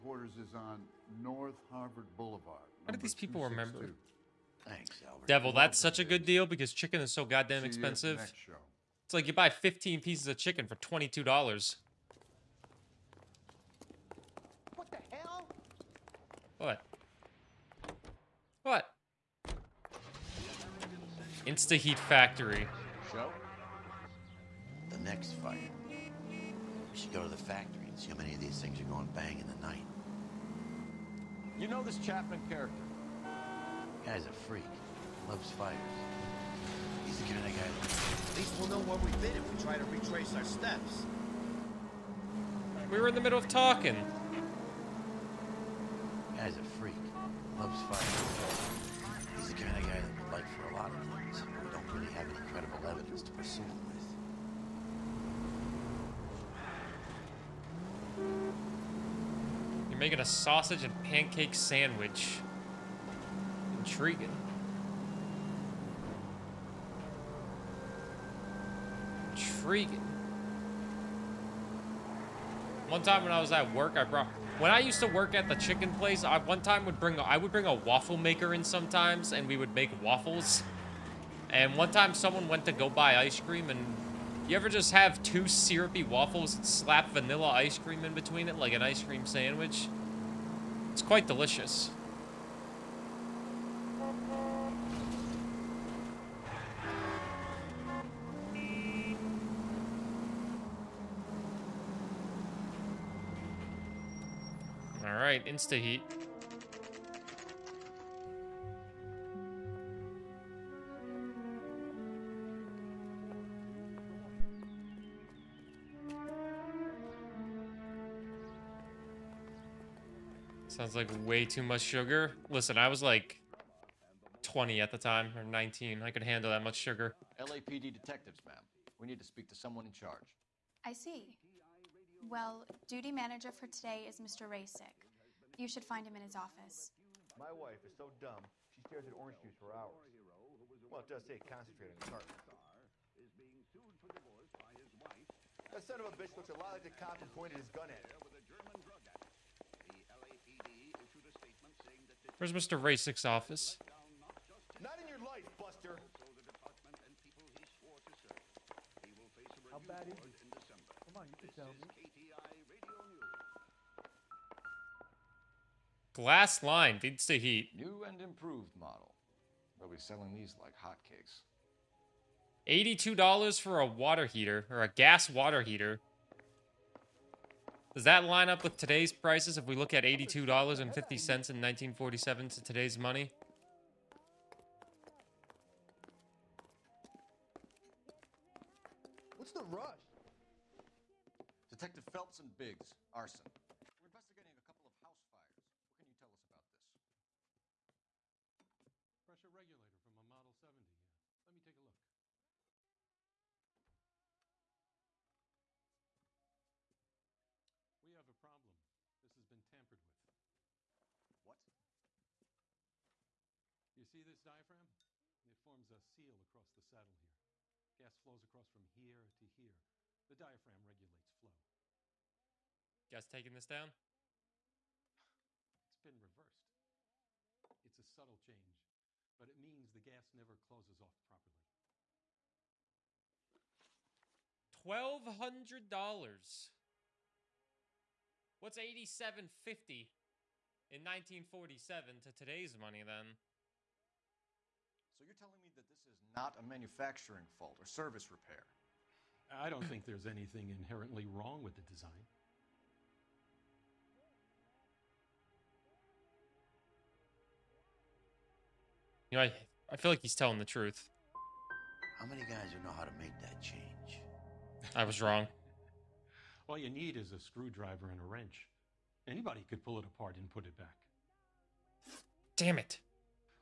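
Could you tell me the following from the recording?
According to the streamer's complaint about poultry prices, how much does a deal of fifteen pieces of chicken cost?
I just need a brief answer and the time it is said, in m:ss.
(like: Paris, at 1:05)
$22, at 0:10.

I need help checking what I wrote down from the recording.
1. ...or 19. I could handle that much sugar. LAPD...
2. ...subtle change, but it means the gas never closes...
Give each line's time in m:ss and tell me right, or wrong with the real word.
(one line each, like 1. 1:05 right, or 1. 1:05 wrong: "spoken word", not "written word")
1. 2:05 right
2. 3:48 right.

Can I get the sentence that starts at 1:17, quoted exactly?
I would bring a waffle maker in sometimes, and we would make waffles.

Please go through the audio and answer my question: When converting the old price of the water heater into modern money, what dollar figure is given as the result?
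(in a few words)
$1,200.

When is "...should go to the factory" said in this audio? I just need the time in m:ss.
0:26.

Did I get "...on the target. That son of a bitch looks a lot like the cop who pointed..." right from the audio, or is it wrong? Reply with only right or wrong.
right.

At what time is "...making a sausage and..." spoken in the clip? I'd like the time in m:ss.
1:00.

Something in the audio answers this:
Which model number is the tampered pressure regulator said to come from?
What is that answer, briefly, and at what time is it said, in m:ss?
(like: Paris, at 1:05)
Model 70, at 3:20.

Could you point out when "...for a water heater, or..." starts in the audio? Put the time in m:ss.
2:53.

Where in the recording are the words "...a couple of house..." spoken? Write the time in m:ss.
3:14.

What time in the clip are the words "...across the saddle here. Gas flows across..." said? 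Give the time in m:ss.
3:36.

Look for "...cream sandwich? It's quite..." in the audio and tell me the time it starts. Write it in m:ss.
1:29.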